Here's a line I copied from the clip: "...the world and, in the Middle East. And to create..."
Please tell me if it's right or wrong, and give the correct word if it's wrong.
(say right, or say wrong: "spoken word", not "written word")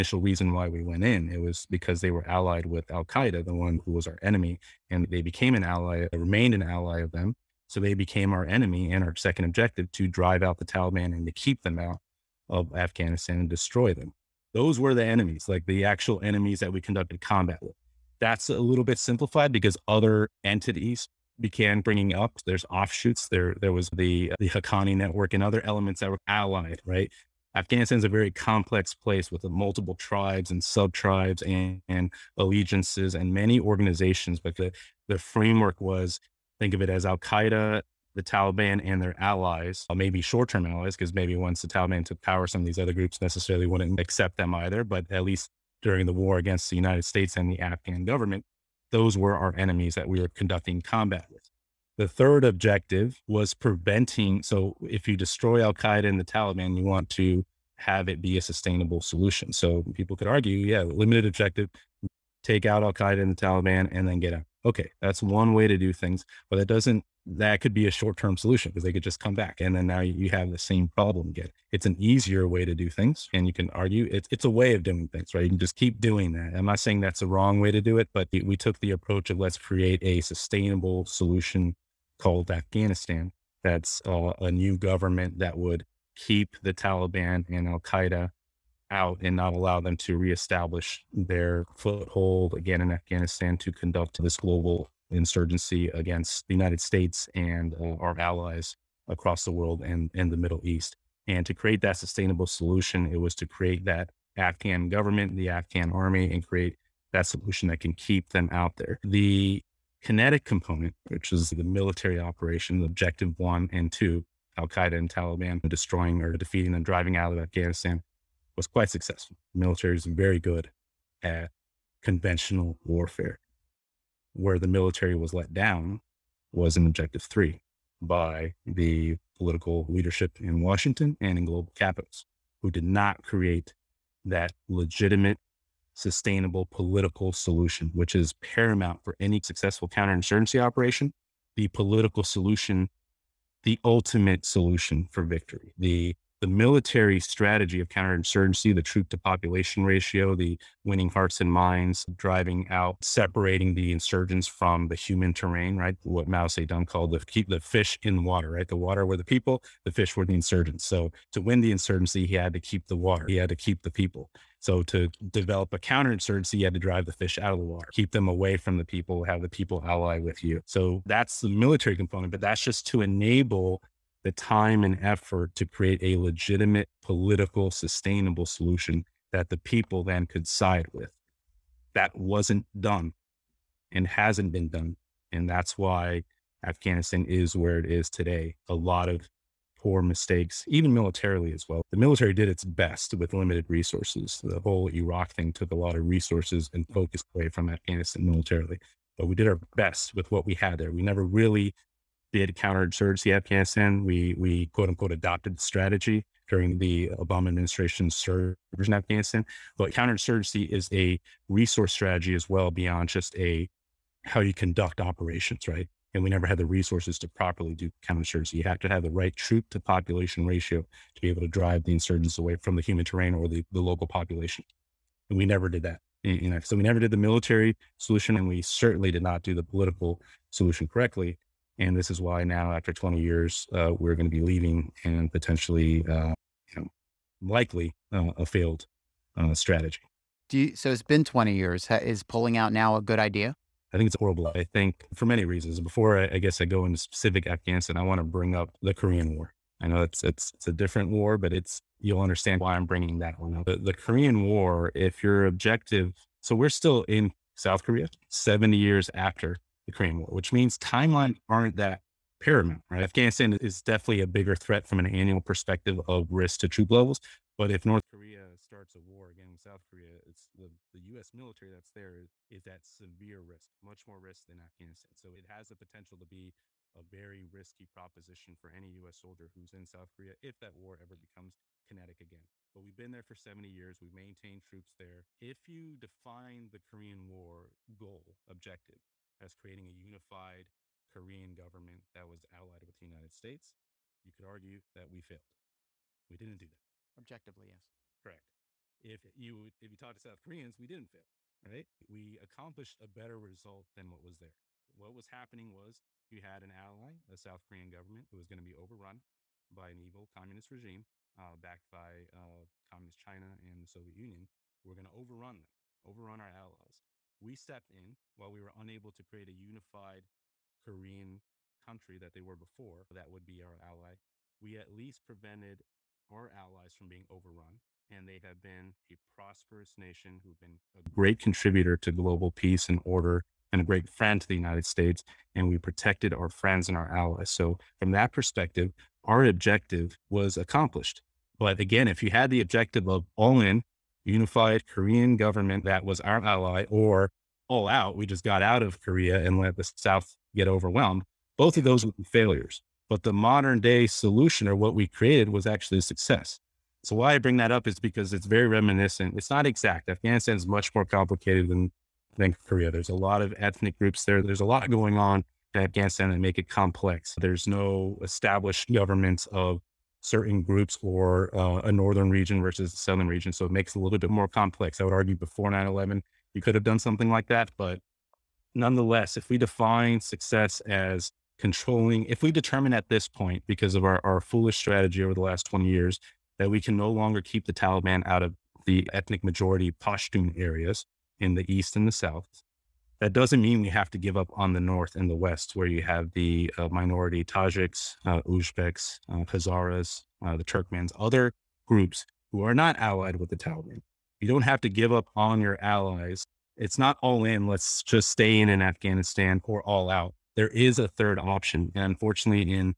right.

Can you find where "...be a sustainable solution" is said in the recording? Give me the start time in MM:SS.
00:58.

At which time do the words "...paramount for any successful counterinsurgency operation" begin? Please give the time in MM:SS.
02:18.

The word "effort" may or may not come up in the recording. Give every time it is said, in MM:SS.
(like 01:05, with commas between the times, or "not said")
02:55.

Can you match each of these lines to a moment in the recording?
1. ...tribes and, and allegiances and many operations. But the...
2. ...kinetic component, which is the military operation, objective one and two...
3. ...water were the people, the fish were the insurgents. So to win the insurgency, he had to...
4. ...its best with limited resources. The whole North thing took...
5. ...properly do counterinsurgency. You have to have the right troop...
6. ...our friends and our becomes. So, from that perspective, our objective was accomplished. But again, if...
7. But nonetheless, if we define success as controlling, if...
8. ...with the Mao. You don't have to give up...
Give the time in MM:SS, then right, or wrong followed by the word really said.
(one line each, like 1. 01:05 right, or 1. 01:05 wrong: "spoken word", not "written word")
1. 00:30 wrong: "organizations", not "operations"
2. 01:50 right
3. 02:38 right
4. 03:12 wrong: "Iraq", not "North"
5. 03:37 right
6. 05:36 wrong: "allies", not "becomes"
7. 06:17 right
8. 06:43 wrong: "Taliban", not "Mao".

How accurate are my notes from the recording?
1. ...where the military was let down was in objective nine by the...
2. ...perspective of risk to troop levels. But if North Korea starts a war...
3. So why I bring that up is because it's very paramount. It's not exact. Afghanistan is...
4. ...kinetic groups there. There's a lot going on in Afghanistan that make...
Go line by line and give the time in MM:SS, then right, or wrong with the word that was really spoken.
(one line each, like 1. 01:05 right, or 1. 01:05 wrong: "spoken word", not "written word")
1. 02:04 wrong: "three", not "nine"
2. 04:25 right
3. 05:57 wrong: "reminiscent", not "paramount"
4. 06:03 wrong: "ethnic", not "kinetic".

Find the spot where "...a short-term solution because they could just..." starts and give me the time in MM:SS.
01:07.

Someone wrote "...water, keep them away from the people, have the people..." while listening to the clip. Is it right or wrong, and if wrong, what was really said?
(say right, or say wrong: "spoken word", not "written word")
right.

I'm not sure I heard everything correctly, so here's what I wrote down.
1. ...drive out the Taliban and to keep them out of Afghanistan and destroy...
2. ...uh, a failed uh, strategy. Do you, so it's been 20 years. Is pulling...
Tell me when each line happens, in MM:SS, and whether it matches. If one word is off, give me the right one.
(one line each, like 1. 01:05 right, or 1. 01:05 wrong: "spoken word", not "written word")
1. 00:10 right
2. 03:58 right.